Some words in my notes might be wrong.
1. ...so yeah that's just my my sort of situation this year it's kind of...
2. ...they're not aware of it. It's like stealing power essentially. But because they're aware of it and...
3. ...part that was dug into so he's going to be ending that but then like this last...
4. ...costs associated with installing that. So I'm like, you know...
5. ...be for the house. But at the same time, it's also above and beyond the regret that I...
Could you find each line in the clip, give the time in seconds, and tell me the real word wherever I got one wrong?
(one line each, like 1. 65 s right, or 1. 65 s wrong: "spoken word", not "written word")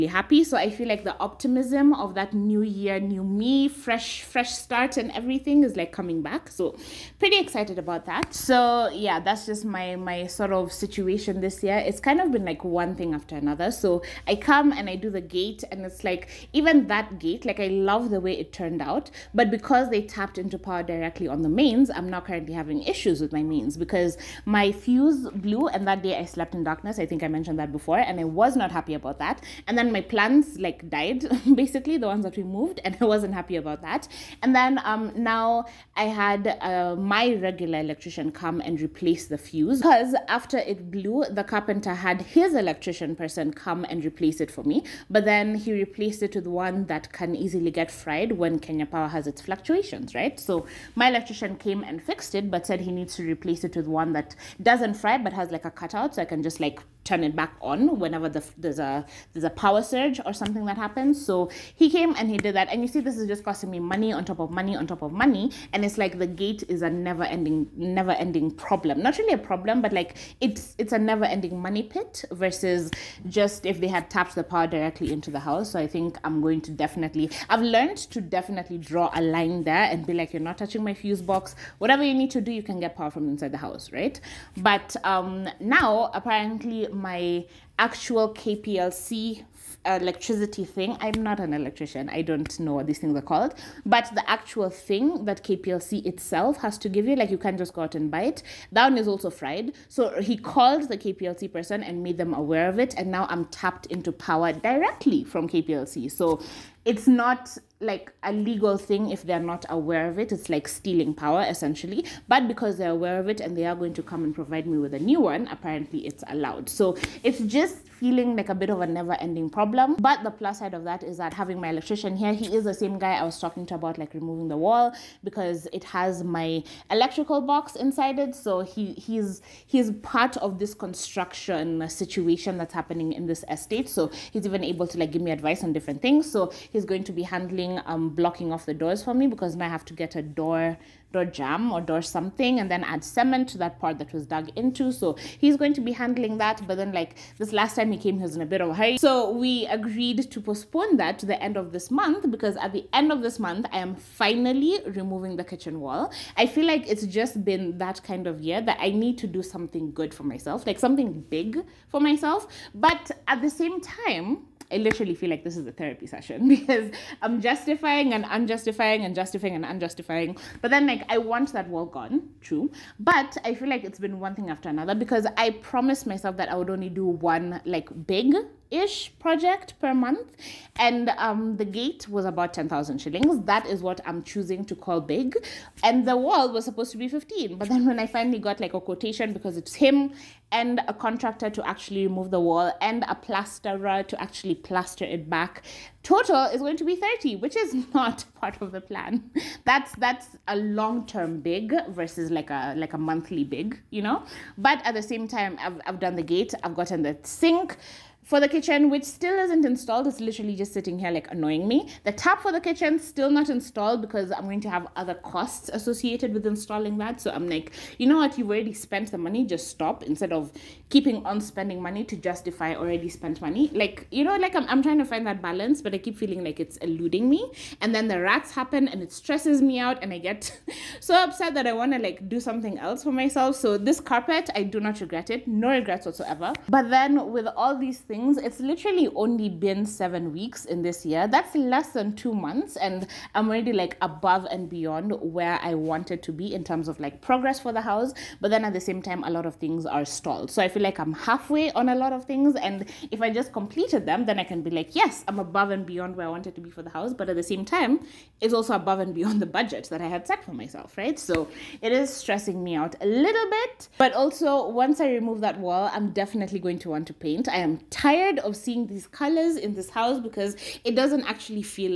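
1. 8 s right
2. 109 s right
3. 143 s wrong: "handling", not "ending"
4. 215 s right
5. 256 s wrong: "budget", not "regret".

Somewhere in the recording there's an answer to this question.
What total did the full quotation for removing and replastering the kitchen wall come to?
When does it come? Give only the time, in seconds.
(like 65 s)
196 s.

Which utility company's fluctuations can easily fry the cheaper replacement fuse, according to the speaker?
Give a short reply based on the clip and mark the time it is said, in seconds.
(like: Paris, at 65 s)
Kenya Power, at 48 s.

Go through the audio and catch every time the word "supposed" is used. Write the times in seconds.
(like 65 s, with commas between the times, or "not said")
186 s.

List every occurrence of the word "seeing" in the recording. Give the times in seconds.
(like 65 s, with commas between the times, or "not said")
268 s.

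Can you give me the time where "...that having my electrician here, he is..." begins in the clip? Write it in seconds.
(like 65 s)
121 s.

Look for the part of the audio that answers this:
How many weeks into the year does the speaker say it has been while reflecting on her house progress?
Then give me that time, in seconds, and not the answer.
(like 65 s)
239 s.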